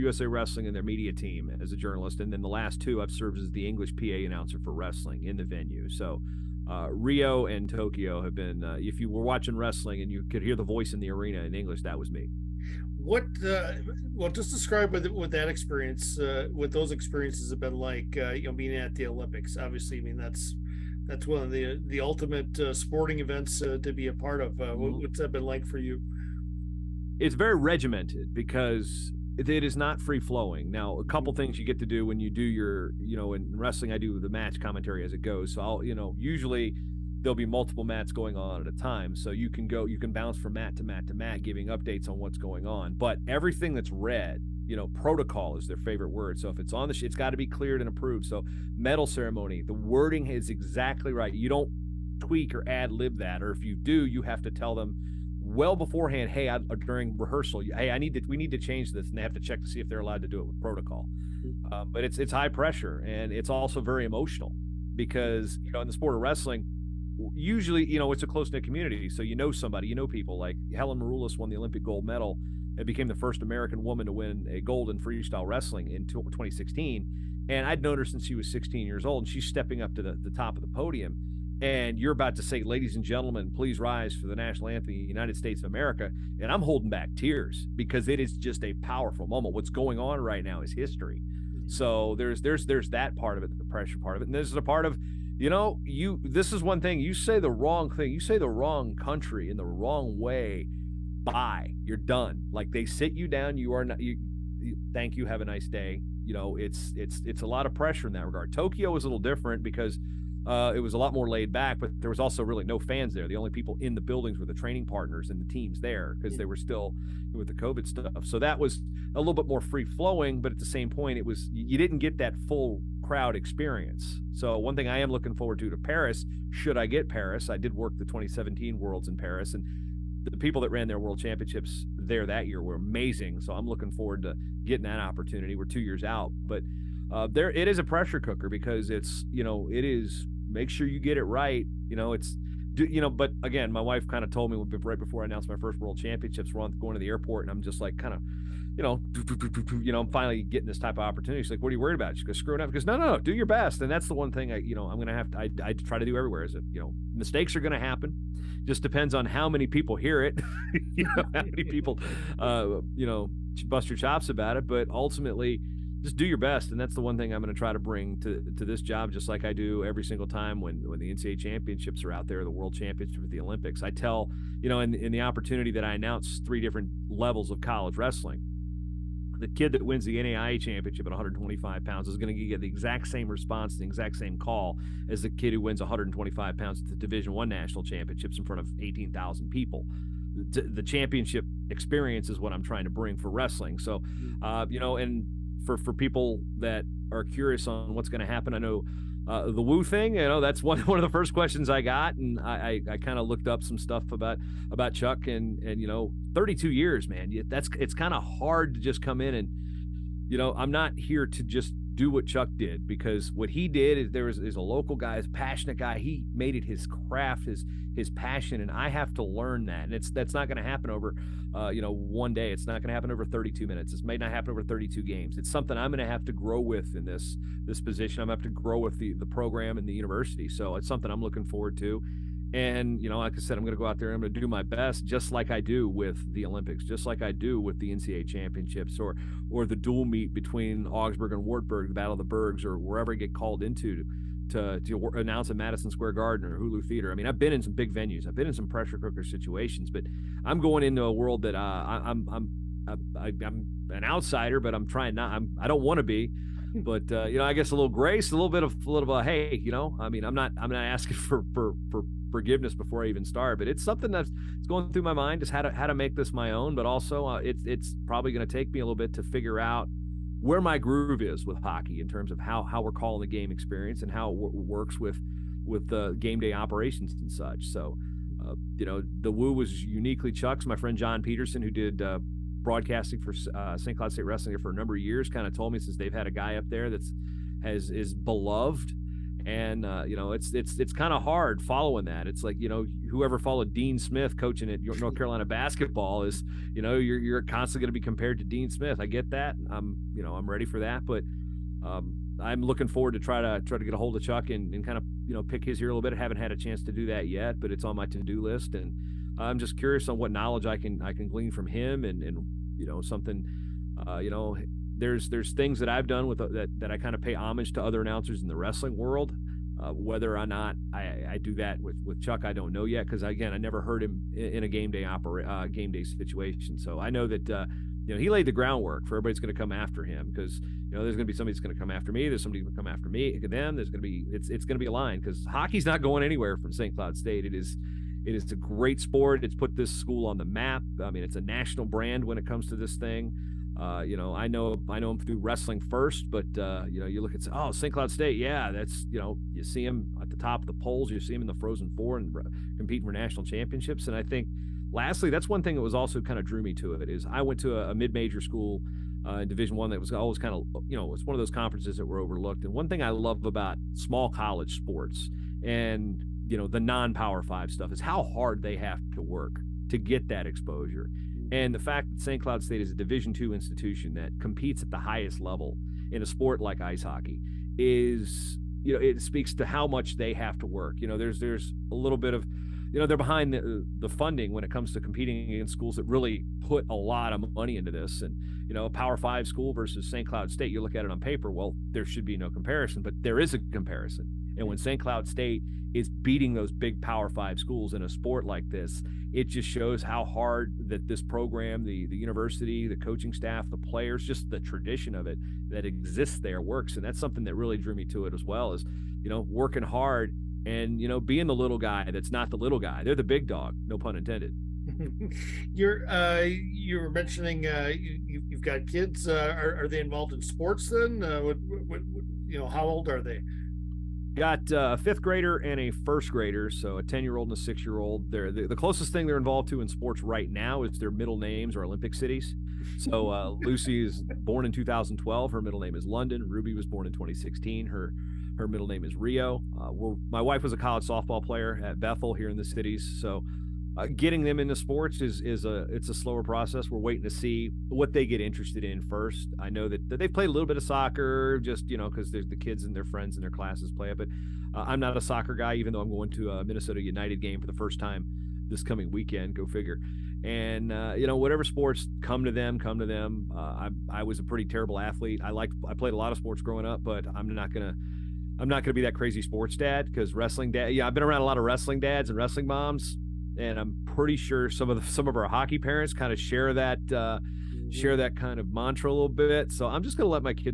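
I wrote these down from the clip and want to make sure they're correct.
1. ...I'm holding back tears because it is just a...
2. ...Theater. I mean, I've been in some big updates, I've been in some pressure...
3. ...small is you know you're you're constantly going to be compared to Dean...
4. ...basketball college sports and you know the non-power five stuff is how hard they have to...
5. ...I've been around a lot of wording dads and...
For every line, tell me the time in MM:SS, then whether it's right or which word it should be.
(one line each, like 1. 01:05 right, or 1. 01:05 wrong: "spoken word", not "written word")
1. 01:26 right
2. 04:06 wrong: "venues", not "updates"
3. 04:55 wrong: "basketball", not "small"
4. 06:03 wrong: "small", not "basketball"
5. 07:51 wrong: "wrestling", not "wording".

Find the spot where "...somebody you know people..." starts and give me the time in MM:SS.
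01:09.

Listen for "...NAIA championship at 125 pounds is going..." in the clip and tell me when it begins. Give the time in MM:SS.
03:00.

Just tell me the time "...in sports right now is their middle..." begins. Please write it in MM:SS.
07:09.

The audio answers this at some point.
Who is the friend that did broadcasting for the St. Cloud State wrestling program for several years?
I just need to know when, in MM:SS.
04:40.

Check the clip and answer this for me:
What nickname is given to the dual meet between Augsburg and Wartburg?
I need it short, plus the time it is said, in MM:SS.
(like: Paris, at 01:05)
Battle of the Bergs, at 04:01.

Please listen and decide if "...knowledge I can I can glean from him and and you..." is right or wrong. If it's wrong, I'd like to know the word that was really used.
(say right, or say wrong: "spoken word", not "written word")
right.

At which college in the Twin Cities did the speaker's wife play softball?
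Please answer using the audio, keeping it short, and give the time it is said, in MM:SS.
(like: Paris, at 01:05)
Bethel, at 07:21.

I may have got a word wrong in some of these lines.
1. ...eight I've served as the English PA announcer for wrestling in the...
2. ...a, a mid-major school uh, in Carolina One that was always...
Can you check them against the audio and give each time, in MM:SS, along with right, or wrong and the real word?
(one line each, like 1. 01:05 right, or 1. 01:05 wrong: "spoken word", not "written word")
1. 00:02 wrong: "two", not "eight"
2. 05:57 wrong: "Division", not "Carolina".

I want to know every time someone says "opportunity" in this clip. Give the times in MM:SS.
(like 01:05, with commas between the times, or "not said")
02:14, 02:31, 02:55.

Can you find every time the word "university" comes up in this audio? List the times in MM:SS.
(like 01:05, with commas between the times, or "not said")
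03:49, 06:42.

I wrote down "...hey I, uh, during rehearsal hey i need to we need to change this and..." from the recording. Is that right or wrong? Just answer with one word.
right.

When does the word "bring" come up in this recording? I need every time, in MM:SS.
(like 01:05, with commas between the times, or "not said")
02:47, 03:12.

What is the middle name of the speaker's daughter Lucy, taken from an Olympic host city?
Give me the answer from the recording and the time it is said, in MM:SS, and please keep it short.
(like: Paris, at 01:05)
London, at 07:16.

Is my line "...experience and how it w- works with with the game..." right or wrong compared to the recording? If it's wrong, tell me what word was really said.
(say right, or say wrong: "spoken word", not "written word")
right.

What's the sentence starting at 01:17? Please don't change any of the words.
And I'd known her since she was 16 years old, and she's stepping up to the, the top of the podium.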